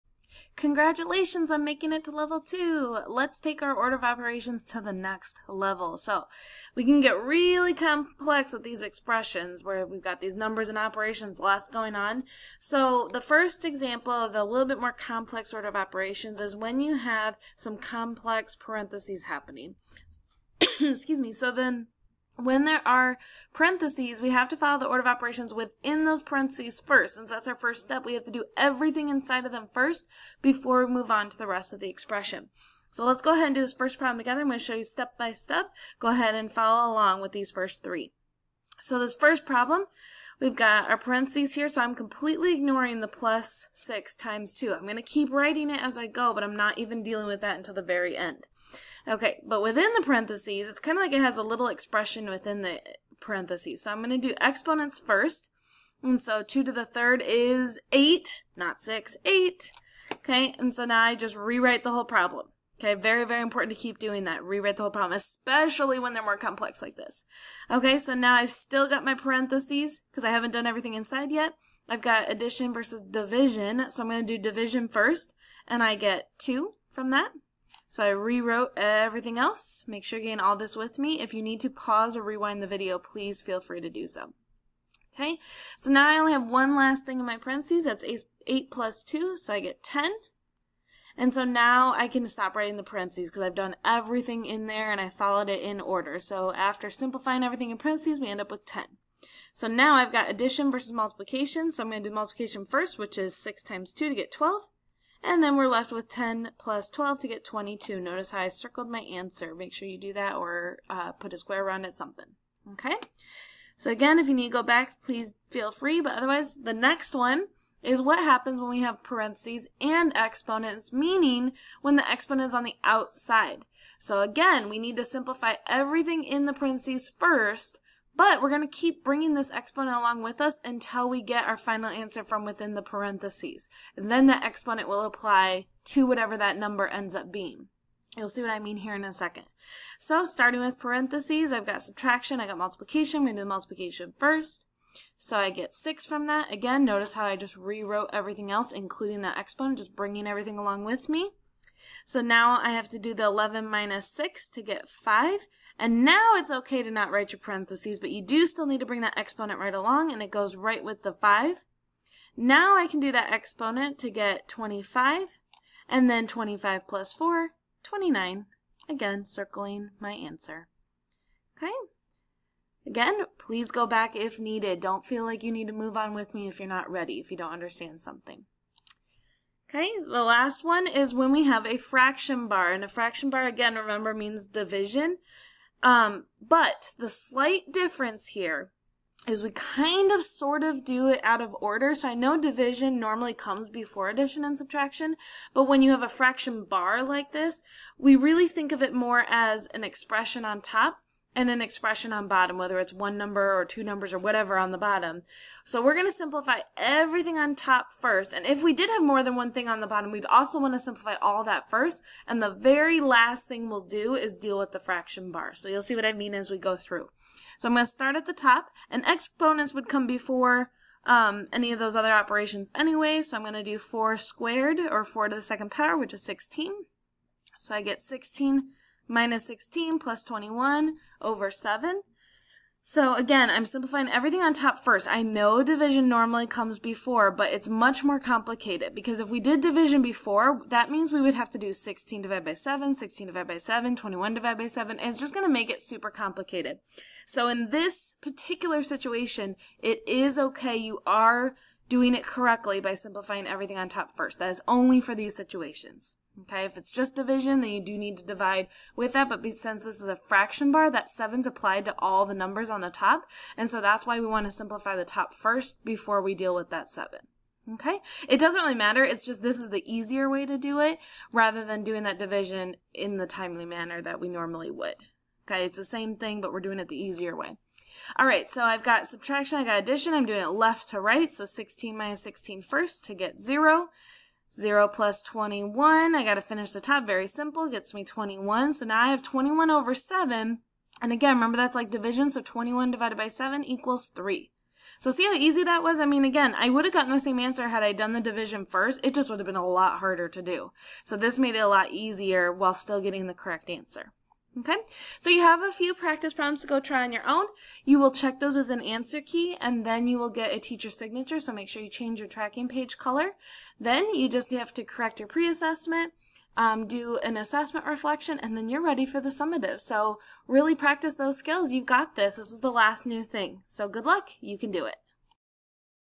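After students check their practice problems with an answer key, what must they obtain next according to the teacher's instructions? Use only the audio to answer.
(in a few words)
teacher signature.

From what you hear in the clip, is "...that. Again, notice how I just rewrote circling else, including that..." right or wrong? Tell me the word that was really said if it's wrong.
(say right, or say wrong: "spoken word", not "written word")
wrong: "everything", not "circling".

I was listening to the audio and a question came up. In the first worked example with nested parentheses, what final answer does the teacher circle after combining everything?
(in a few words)
22.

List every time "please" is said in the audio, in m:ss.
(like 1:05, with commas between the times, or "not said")
1:22, 1:55, 2:53.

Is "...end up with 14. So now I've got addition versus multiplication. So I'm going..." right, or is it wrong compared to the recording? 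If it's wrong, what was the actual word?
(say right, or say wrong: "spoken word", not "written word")
wrong: "10", not "14".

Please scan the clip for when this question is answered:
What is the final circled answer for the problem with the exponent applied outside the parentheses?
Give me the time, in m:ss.
2:47.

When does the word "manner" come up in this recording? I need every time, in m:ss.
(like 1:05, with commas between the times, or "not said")
4:33.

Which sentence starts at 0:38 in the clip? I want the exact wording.
So this first problem, we've got our parentheses here, so I'm completely ignoring the plus 6 times 2.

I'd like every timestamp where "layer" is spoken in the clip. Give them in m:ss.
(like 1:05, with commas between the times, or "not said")
not said.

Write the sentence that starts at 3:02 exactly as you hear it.
And a fraction bar, again, remember, means division.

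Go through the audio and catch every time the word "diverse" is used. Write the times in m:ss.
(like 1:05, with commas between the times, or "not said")
not said.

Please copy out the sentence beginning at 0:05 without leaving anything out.
So we can get really complex with these expressions where we've got these numbers and operations, lots going on.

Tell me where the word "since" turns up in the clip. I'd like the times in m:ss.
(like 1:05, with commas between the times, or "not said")
0:27, 4:19.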